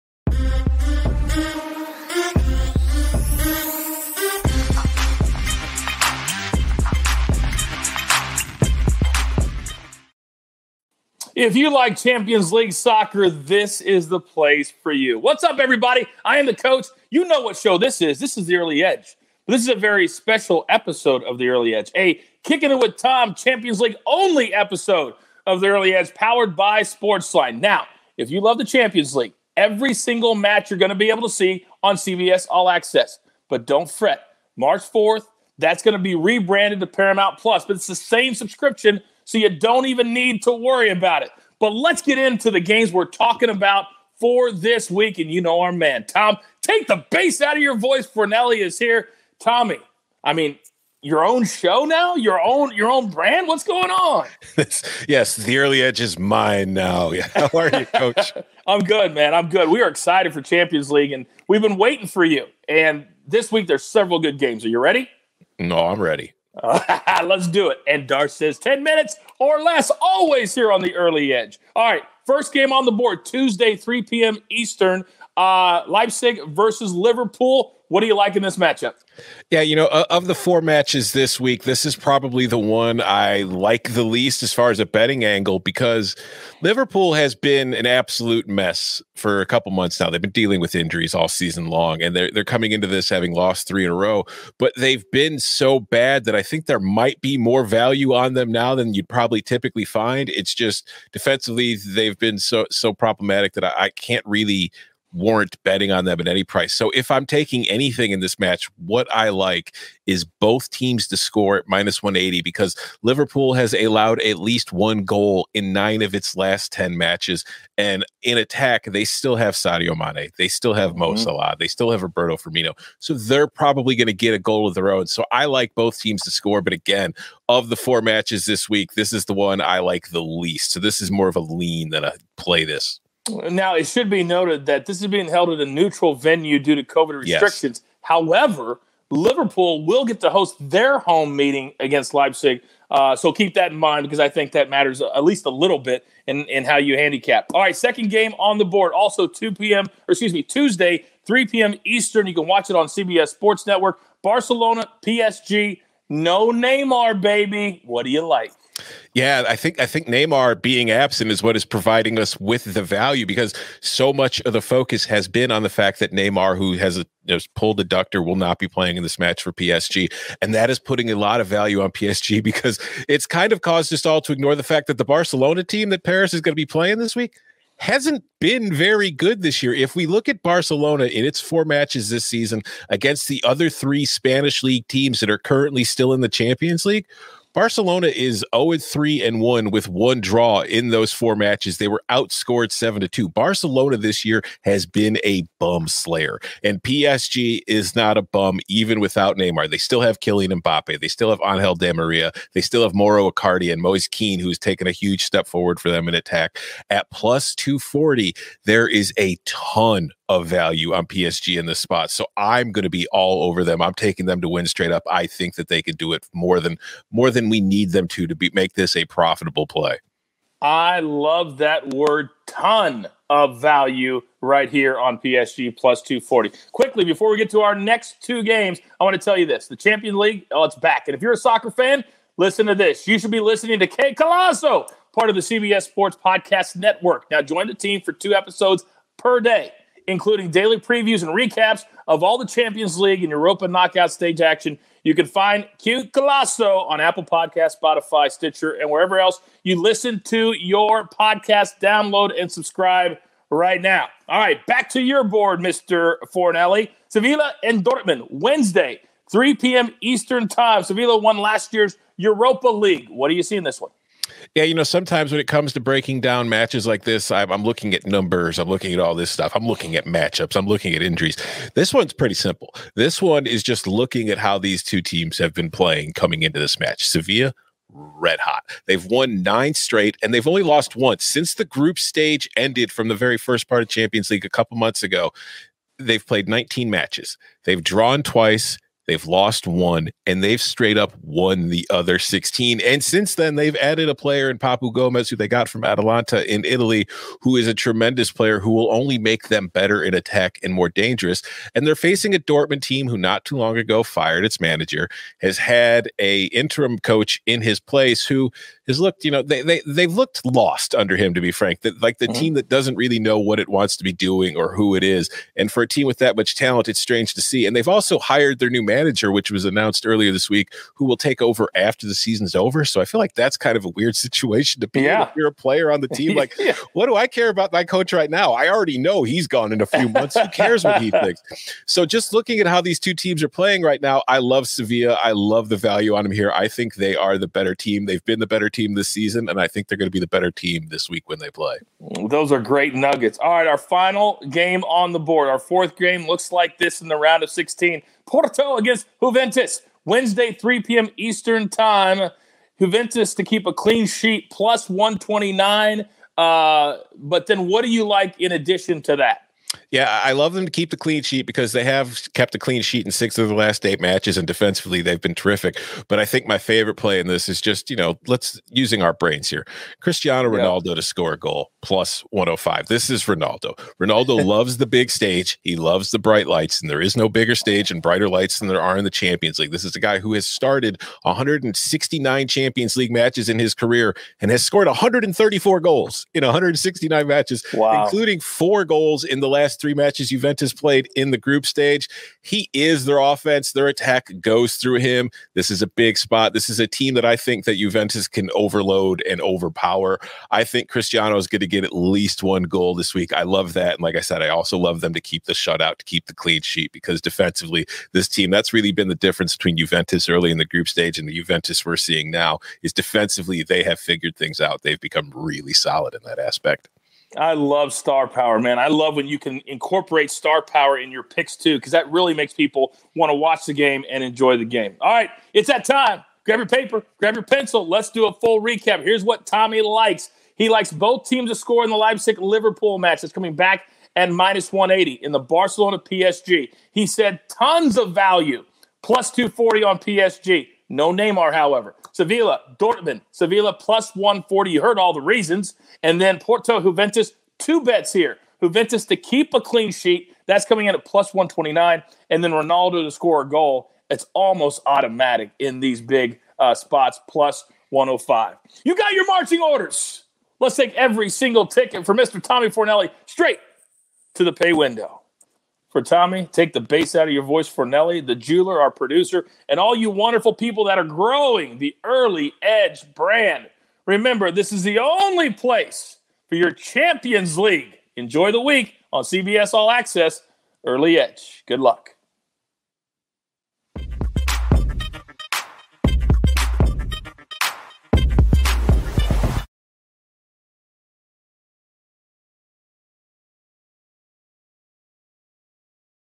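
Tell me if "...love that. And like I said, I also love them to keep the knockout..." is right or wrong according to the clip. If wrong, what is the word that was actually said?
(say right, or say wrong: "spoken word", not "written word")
wrong: "shutout", not "knockout".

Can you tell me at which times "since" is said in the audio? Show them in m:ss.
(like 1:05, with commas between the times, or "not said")
4:41, 4:53.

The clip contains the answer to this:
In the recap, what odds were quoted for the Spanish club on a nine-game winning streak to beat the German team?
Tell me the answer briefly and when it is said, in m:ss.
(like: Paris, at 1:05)
+140, at 7:23.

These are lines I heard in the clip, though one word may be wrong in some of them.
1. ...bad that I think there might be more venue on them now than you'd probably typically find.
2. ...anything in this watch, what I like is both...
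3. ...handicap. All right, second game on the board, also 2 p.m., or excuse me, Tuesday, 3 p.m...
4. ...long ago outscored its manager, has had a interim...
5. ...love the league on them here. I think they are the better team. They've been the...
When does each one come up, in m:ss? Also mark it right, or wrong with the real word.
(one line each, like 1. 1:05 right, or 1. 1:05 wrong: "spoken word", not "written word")
1. 1:35 wrong: "value", not "venue"
2. 1:47 wrong: "match", not "watch"
3. 2:26 right
4. 5:03 wrong: "fired", not "outscored"
5. 5:35 wrong: "value", not "league".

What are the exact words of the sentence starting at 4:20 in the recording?
Sevilla won last year's Europa League.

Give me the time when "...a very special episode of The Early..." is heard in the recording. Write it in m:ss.
0:19.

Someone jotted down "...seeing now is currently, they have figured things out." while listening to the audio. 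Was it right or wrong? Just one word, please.
wrong.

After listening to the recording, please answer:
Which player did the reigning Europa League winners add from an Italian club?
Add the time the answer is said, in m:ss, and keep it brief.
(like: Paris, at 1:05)
Papu Gomez, at 4:54.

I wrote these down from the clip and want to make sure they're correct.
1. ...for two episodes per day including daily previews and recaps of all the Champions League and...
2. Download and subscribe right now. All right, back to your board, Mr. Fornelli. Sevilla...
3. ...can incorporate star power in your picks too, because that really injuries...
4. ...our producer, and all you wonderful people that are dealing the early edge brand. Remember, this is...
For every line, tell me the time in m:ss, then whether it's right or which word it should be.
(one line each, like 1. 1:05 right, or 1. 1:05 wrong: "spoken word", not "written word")
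1. 3:58 right
2. 4:11 right
3. 6:59 wrong: "makes", not "injuries"
4. 7:48 wrong: "growing", not "dealing".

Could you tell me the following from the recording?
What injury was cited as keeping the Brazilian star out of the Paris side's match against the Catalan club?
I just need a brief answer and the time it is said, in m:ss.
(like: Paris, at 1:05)
pulled adductor, at 2:47.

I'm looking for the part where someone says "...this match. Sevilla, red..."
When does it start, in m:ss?
4:36.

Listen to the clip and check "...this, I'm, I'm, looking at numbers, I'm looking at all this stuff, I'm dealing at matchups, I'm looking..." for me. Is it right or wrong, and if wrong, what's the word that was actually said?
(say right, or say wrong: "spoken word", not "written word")
wrong: "looking", not "dealing".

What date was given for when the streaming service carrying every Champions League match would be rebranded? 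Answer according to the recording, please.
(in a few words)
March 4.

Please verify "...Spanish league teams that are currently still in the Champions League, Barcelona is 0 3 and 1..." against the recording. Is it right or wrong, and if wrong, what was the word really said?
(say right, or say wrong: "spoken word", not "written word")
right.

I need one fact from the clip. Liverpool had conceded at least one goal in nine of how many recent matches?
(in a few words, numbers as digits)
10.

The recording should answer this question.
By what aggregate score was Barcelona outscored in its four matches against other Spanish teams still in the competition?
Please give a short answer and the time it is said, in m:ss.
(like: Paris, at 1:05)
7 to 2, at 3:12.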